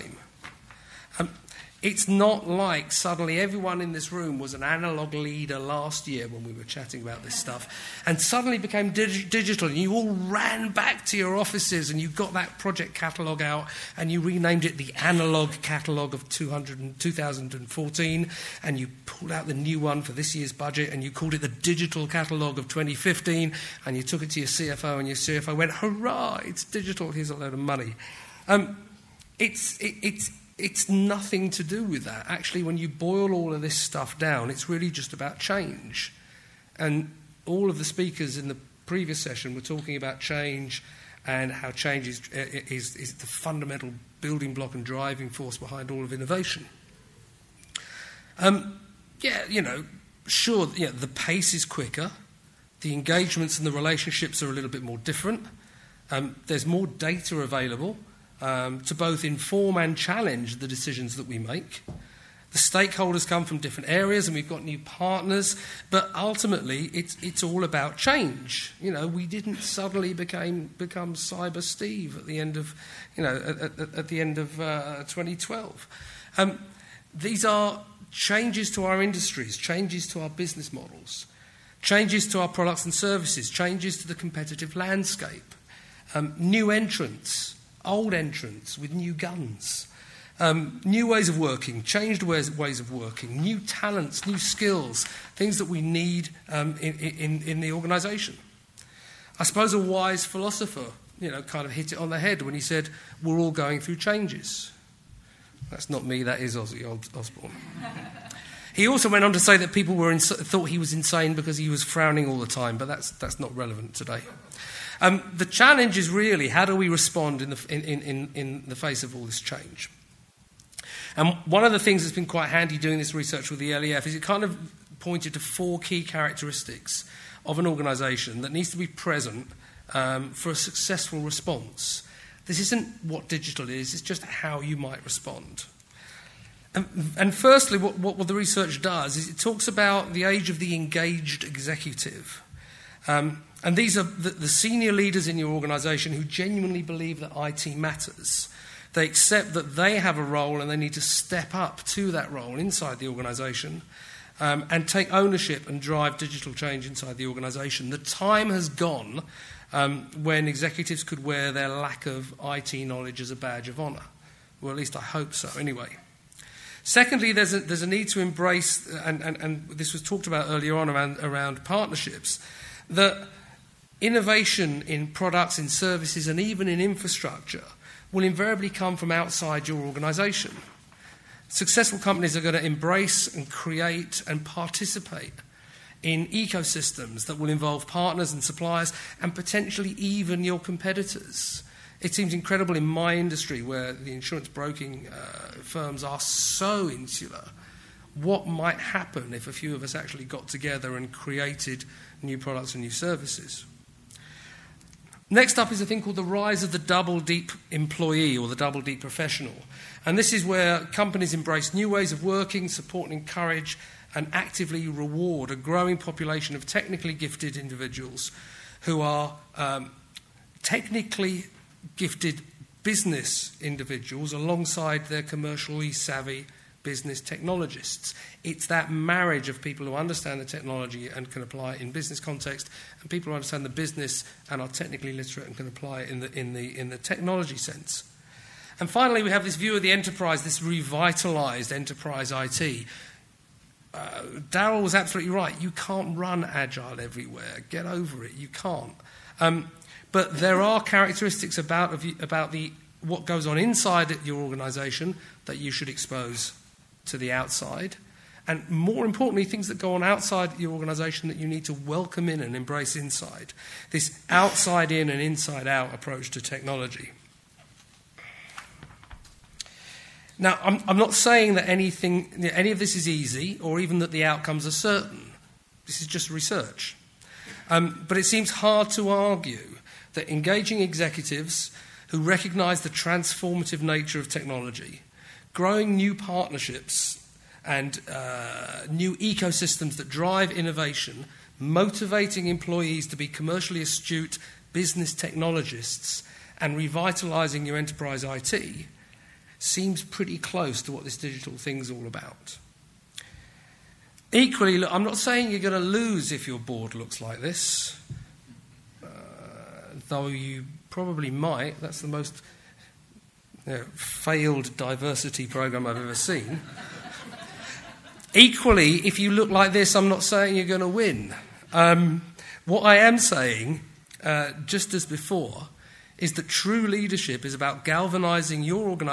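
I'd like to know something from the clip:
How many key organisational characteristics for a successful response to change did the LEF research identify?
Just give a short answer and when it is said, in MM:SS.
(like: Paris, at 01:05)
4, at 02:05.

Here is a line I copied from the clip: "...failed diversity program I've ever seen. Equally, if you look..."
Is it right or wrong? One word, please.
right.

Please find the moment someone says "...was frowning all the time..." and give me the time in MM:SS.
01:51.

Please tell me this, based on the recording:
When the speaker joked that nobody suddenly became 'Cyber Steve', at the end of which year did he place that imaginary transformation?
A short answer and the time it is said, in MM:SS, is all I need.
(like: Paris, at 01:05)
2012, at 01:15.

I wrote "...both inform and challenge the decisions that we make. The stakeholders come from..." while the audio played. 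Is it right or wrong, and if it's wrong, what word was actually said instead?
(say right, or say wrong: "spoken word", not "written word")
right.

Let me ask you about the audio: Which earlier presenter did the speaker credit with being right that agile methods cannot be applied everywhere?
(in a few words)
Daryl.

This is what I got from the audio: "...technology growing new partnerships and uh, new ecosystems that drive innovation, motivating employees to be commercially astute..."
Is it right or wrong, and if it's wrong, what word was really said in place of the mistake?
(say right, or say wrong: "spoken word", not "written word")
right.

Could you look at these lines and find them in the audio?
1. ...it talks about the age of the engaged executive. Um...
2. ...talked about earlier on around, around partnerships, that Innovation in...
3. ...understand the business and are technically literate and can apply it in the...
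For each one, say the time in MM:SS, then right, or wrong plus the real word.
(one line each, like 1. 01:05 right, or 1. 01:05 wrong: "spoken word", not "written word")
1. 02:19 right
2. 02:50 right
3. 03:53 right.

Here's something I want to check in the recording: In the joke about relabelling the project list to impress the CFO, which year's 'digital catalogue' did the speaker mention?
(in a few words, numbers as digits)
2015.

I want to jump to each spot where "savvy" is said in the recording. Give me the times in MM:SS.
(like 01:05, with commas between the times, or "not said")
03:45.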